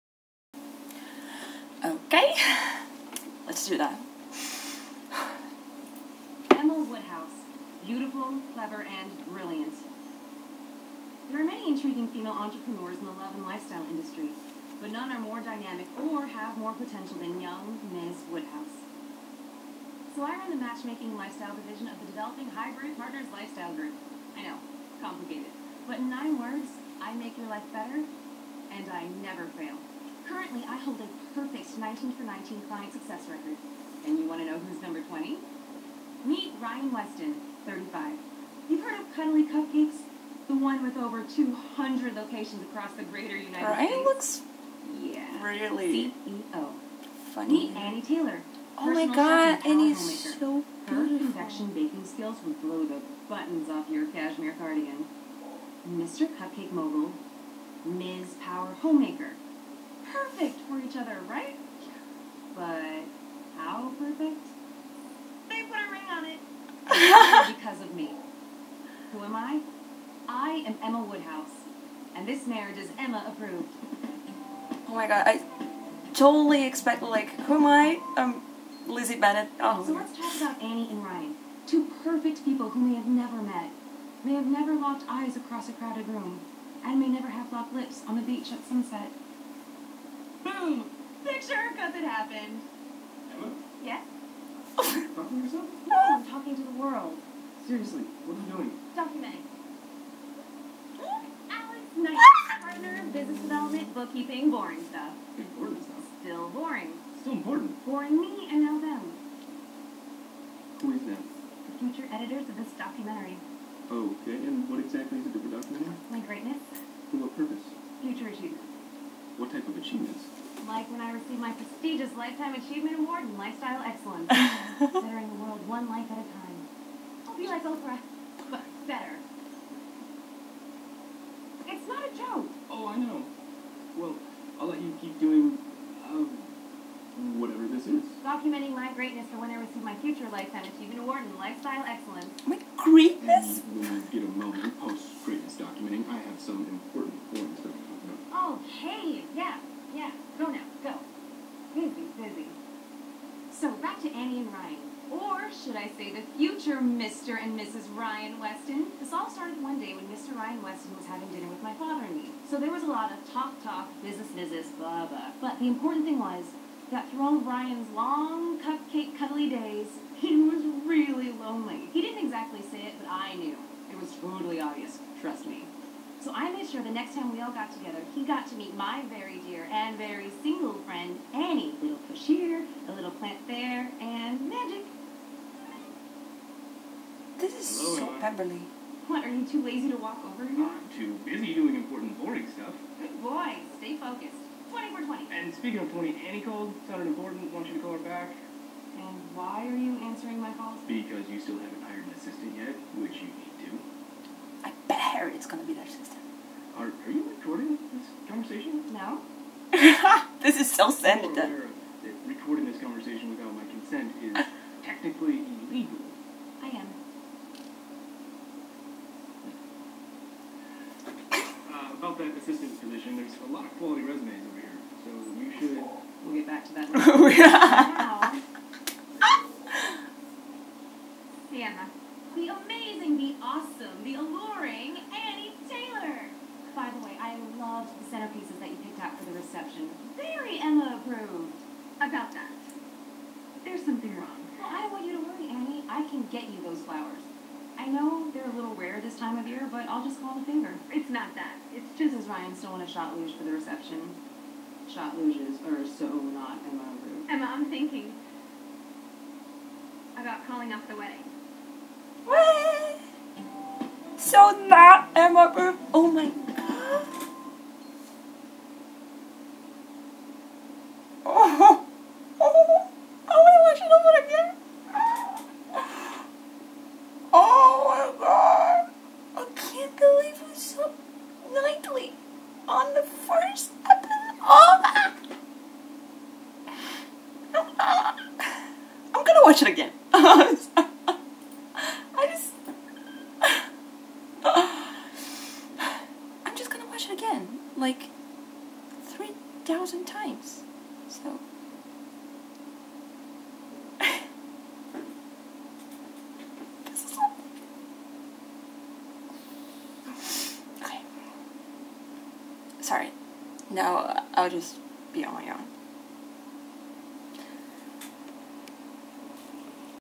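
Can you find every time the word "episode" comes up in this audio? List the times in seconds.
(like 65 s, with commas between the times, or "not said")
283 s.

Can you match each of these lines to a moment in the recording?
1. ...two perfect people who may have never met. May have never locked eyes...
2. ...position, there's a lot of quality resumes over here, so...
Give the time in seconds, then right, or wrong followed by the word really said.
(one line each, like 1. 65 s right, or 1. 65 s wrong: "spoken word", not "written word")
1. 81 s right
2. 222 s right.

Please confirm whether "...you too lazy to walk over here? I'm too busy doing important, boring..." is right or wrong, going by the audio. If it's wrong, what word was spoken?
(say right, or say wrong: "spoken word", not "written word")
right.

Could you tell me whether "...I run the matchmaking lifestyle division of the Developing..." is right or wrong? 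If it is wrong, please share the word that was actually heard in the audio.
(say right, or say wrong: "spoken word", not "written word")
right.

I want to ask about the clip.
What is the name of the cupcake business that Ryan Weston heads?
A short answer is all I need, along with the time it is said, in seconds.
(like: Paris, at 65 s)
Cuddly Cupcakes, at 39 s.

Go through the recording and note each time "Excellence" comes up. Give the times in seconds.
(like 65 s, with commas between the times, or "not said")
123 s, 141 s.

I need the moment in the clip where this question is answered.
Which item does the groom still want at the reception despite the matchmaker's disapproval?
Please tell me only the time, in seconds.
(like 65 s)
252 s.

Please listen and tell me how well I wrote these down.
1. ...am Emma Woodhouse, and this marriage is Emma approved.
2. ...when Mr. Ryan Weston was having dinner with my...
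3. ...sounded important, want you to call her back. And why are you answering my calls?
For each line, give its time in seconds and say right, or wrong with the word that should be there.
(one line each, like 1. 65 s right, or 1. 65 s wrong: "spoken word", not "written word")
1. 70 s right
2. 159 s right
3. 196 s right.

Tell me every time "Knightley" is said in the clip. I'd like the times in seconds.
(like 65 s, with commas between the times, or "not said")
101 s, 281 s.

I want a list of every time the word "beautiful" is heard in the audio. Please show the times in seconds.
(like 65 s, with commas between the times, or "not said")
7 s, 50 s.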